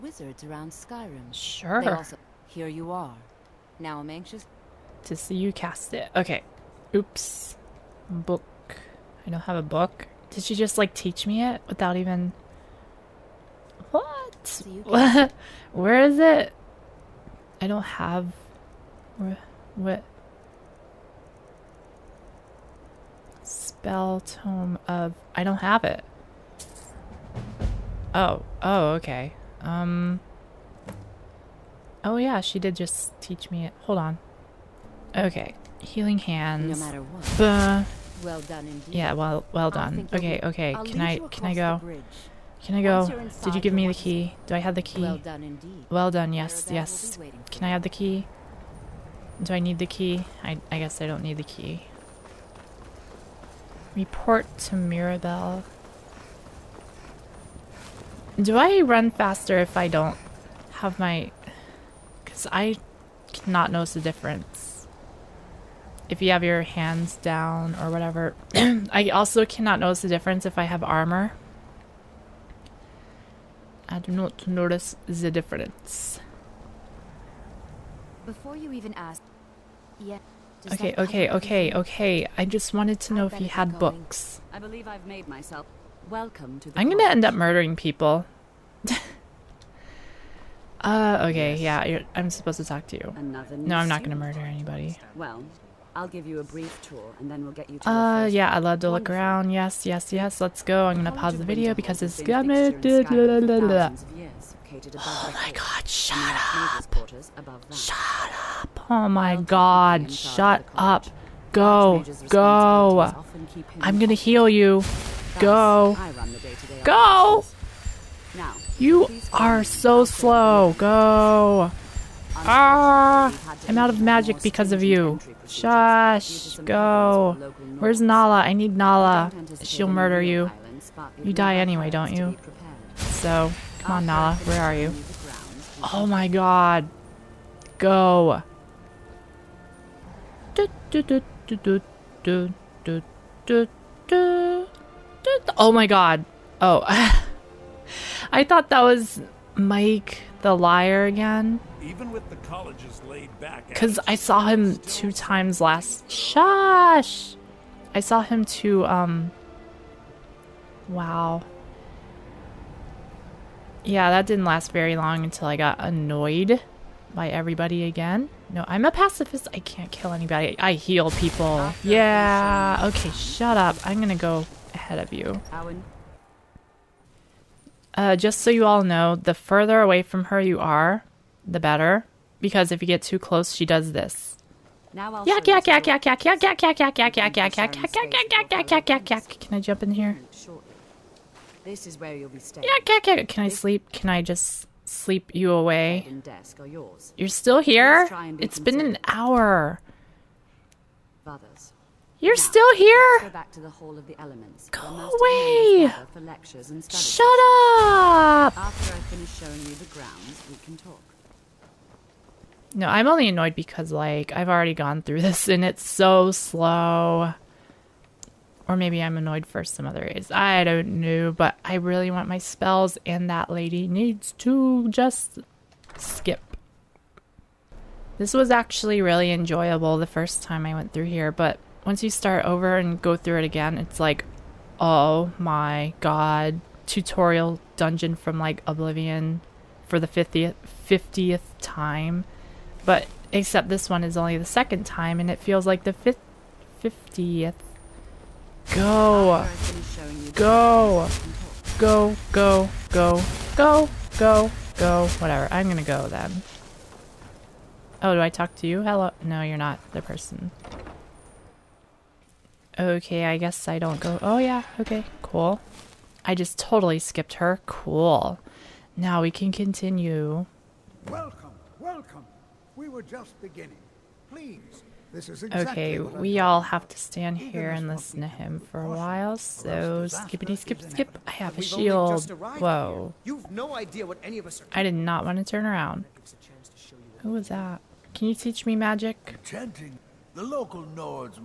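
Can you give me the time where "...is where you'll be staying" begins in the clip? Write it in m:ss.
3:11.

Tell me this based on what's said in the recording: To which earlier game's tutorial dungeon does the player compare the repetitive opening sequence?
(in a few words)
Oblivion.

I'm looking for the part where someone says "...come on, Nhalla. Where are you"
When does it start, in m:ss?
2:13.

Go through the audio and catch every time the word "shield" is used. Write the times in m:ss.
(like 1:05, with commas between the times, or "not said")
4:41.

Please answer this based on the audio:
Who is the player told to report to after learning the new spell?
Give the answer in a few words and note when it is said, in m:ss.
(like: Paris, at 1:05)
Mirabelle, at 0:53.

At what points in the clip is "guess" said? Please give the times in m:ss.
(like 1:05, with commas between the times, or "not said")
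0:50, 4:23.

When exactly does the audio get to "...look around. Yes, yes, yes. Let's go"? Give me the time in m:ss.
1:38.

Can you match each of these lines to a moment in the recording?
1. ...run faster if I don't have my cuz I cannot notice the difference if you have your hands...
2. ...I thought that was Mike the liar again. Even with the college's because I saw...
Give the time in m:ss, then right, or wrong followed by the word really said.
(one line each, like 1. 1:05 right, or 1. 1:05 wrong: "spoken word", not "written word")
1. 0:58 right
2. 2:28 right.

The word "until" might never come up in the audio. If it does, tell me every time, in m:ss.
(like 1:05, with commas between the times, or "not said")
2:45.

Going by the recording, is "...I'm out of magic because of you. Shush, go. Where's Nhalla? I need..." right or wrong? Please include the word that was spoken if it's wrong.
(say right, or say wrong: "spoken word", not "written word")
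right.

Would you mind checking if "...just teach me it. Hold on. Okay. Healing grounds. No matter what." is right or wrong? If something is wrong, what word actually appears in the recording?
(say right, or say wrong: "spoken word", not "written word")
wrong: "hands", not "grounds".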